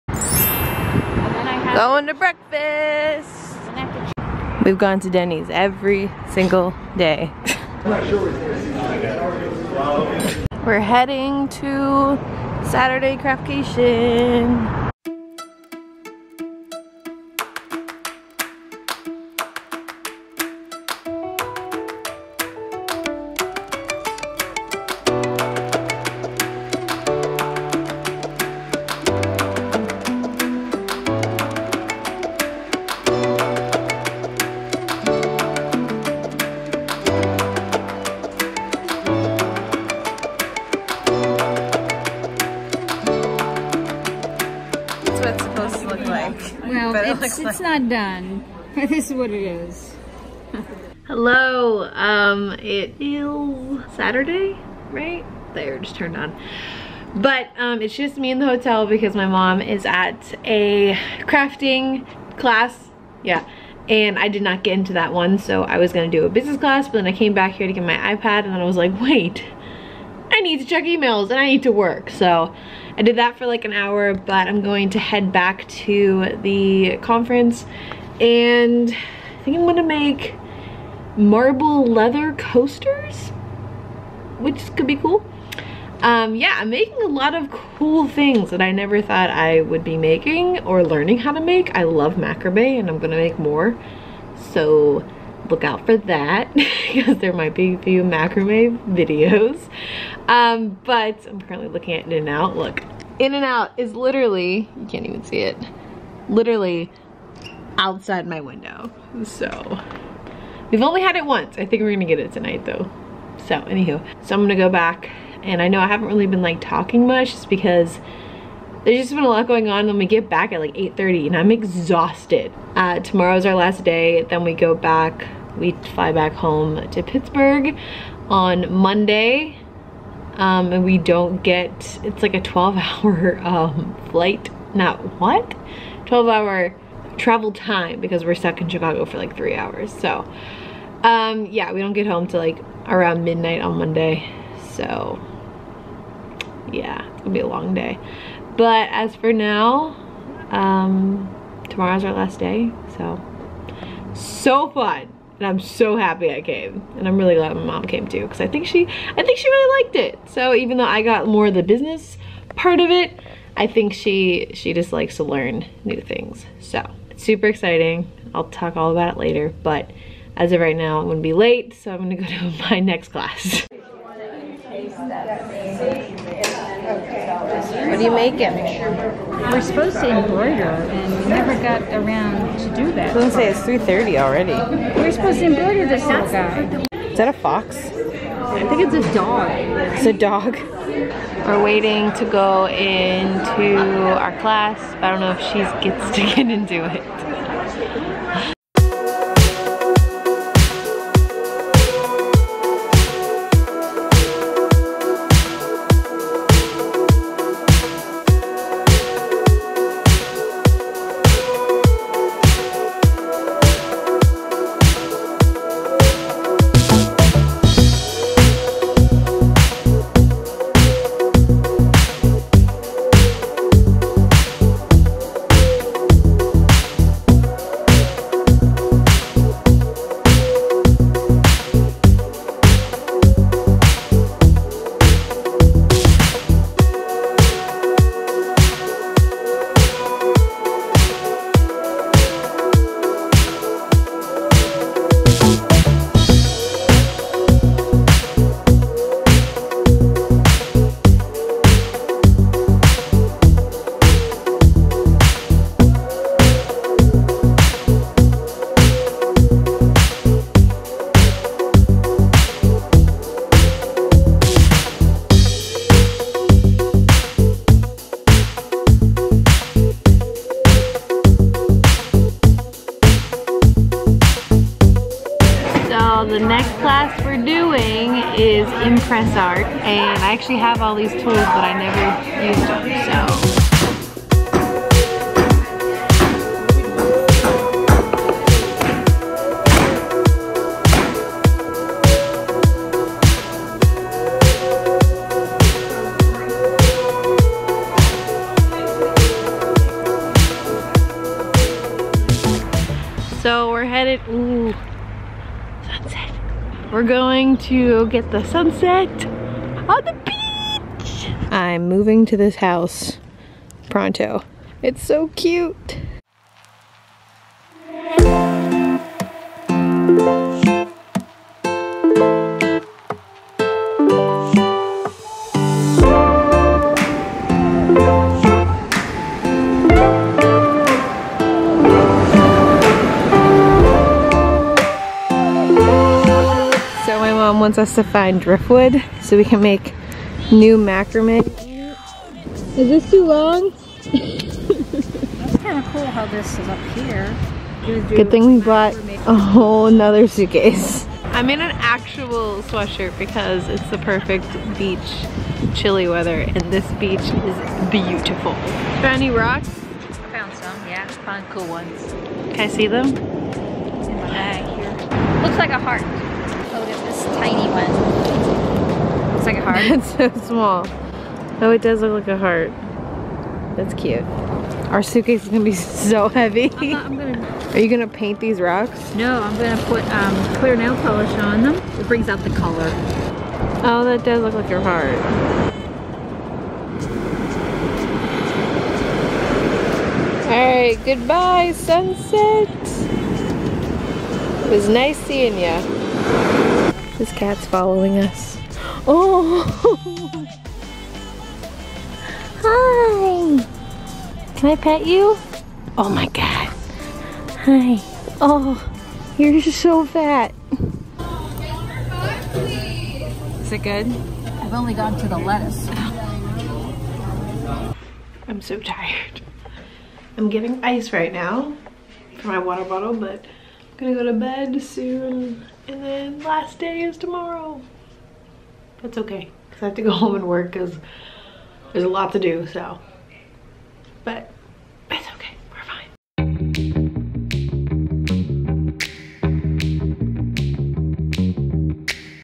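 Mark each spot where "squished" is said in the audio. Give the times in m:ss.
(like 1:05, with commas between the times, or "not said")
not said.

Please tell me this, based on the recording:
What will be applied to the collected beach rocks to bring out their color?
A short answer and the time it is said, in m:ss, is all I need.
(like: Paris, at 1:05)
clear nail polish, at 6:20.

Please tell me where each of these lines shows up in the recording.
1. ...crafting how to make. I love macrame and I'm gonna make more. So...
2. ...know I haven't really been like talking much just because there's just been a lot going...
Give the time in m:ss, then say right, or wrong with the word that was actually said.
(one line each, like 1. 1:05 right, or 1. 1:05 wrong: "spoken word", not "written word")
1. 1:30 wrong: "learning", not "crafting"
2. 1:55 right.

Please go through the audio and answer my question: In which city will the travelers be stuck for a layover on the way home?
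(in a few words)
Chicago.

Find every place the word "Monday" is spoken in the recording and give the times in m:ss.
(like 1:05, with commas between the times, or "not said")
2:08, 2:23.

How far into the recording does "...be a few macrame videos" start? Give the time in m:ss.
1:37.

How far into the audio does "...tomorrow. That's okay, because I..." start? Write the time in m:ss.
7:07.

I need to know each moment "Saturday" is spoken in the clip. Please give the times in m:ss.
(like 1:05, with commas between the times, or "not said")
0:12, 0:53.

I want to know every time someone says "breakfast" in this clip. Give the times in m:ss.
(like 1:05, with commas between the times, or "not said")
0:02.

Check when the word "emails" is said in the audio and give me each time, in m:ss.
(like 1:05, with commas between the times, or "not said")
1:10.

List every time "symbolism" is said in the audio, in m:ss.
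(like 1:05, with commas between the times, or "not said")
not said.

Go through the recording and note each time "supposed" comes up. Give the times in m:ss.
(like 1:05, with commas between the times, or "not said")
2:59, 3:05.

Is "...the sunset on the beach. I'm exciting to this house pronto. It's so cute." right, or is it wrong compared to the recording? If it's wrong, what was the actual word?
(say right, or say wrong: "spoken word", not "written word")
wrong: "moving", not "exciting".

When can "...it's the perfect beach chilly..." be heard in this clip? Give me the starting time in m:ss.
5:53.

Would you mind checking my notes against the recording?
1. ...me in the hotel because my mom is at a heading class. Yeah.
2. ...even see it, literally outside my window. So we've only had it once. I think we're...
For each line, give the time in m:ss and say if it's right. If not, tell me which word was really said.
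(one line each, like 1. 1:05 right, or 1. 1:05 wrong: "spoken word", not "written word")
1. 0:58 wrong: "crafting", not "heading"
2. 1:45 right.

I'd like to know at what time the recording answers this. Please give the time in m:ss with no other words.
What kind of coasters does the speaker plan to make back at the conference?
1:21.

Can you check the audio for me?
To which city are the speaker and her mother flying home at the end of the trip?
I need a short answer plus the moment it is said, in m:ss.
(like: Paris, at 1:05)
Pittsburgh, at 2:07.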